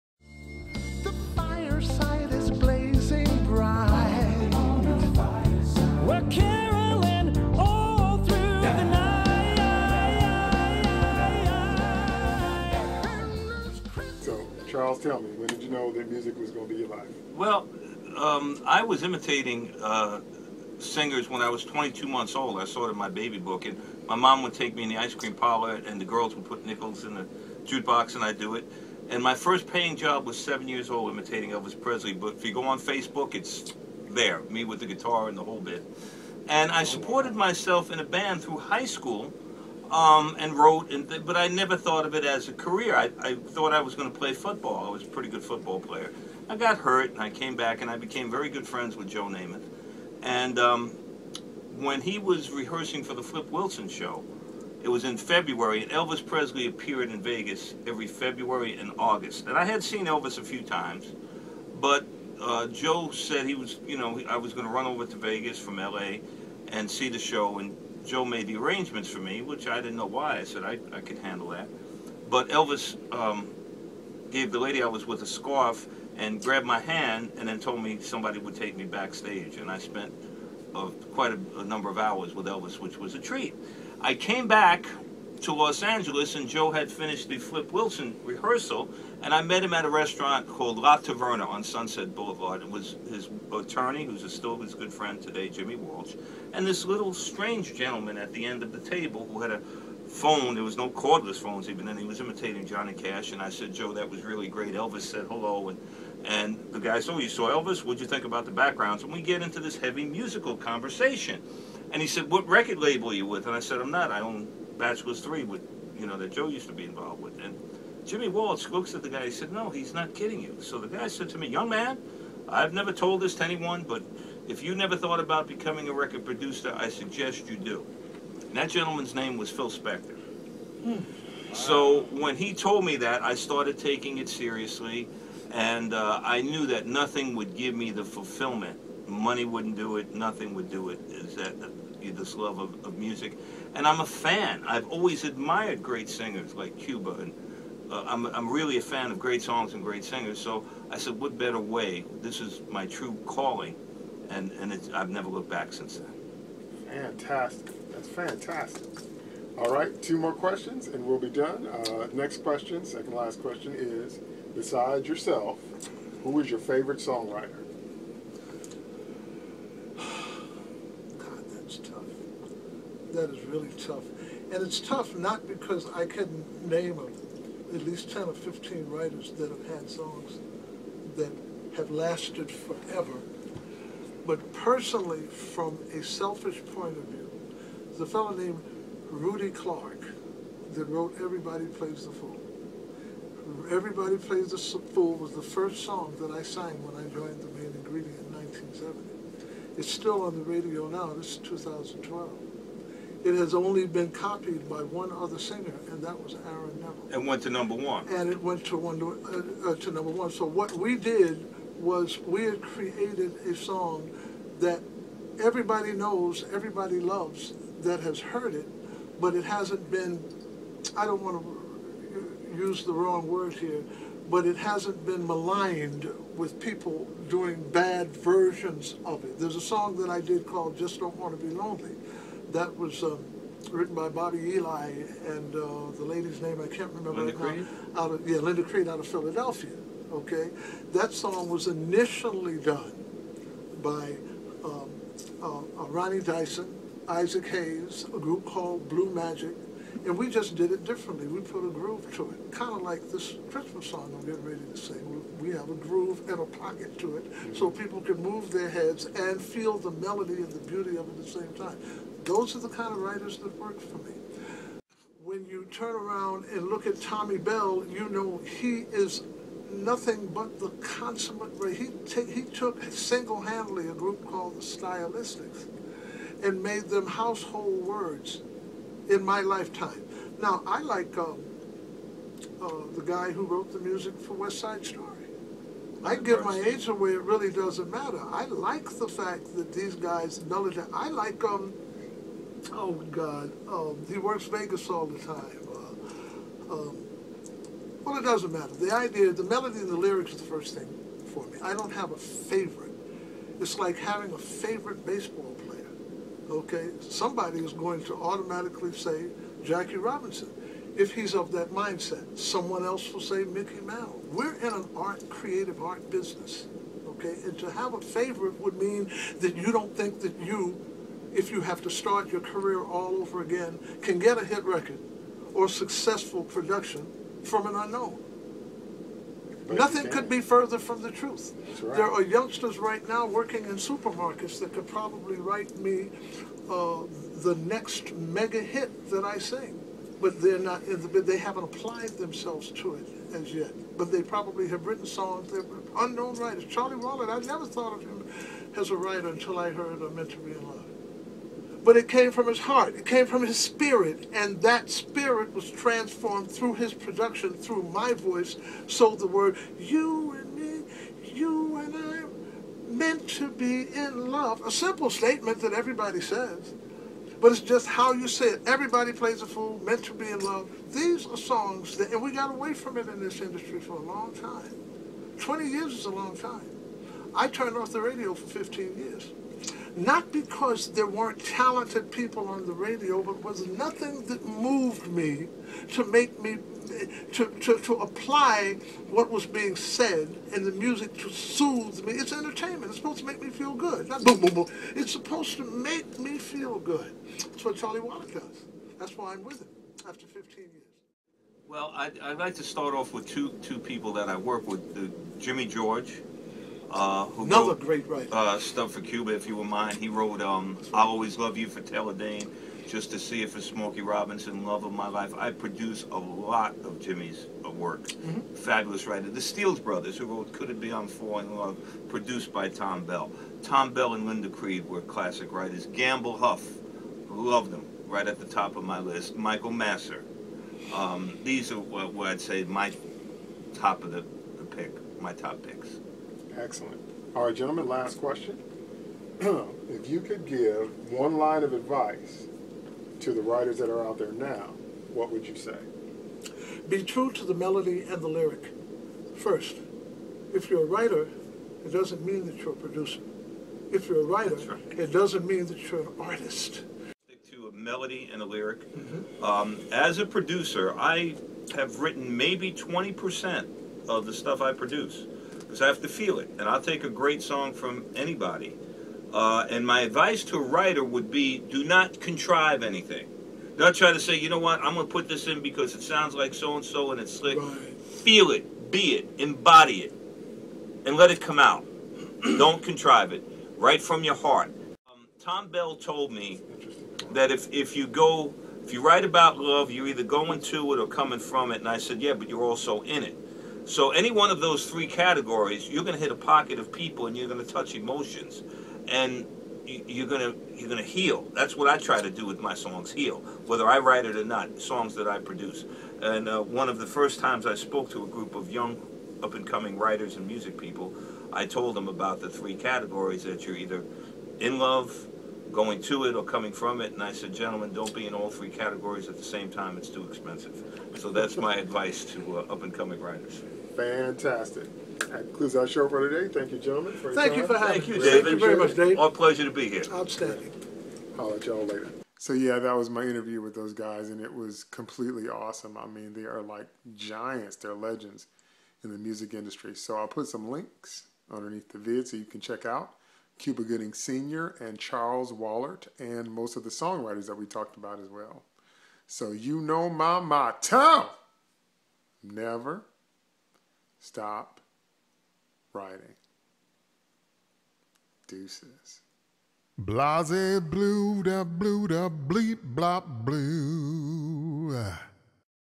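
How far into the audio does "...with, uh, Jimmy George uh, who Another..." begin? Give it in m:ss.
6:44.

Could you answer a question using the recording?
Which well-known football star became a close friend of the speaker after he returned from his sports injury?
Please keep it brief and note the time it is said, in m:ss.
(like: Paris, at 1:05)
Joe Namath, at 0:49.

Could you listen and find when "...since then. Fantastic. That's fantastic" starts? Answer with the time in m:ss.
2:35.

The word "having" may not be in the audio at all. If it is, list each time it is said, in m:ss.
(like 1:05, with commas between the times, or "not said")
5:03, 8:47.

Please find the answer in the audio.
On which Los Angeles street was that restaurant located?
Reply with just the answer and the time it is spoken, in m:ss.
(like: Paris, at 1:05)
Sunset Boulevard, at 1:31.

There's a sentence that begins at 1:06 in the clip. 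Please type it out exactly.
and see the show, and Joe made the arrangements for me, which I didn't know why.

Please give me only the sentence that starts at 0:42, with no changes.
I, I thought I was going to play football.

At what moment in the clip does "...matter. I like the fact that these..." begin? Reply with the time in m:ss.
4:47.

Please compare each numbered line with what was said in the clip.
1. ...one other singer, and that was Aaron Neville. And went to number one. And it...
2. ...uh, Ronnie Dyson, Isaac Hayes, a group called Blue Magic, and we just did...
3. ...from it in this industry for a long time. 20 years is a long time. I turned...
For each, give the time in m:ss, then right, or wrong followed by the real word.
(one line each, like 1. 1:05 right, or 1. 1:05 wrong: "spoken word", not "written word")
1. 3:24 right
2. 4:05 right
3. 6:12 right.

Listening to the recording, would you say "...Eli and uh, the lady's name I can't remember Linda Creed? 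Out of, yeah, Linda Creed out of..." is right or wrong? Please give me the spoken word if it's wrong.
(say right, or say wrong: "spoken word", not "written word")
right.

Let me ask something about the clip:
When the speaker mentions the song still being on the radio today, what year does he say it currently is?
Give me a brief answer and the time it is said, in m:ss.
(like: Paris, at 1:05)
2012, at 3:21.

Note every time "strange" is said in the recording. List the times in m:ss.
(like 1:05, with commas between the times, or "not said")
1:37.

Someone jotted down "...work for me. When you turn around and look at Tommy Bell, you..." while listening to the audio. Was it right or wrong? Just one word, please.
right.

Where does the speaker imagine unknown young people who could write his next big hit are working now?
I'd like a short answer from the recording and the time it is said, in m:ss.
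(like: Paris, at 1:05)
supermarkets, at 5:33.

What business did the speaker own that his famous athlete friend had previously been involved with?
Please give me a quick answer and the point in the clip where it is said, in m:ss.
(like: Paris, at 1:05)
Bachelor's Three, at 1:54.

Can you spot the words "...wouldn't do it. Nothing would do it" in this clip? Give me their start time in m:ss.
2:19.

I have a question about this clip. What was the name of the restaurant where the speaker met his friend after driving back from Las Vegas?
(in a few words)
La Taverna.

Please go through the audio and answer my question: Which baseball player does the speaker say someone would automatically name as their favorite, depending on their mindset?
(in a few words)
Jackie Robinson.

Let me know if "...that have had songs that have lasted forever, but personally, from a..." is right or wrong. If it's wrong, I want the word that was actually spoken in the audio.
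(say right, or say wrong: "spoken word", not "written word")
right.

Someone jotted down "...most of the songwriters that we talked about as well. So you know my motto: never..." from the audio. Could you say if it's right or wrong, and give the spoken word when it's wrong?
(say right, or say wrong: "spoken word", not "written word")
right.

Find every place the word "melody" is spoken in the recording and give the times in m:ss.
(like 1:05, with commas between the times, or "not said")
4:19, 4:59, 7:27, 7:37.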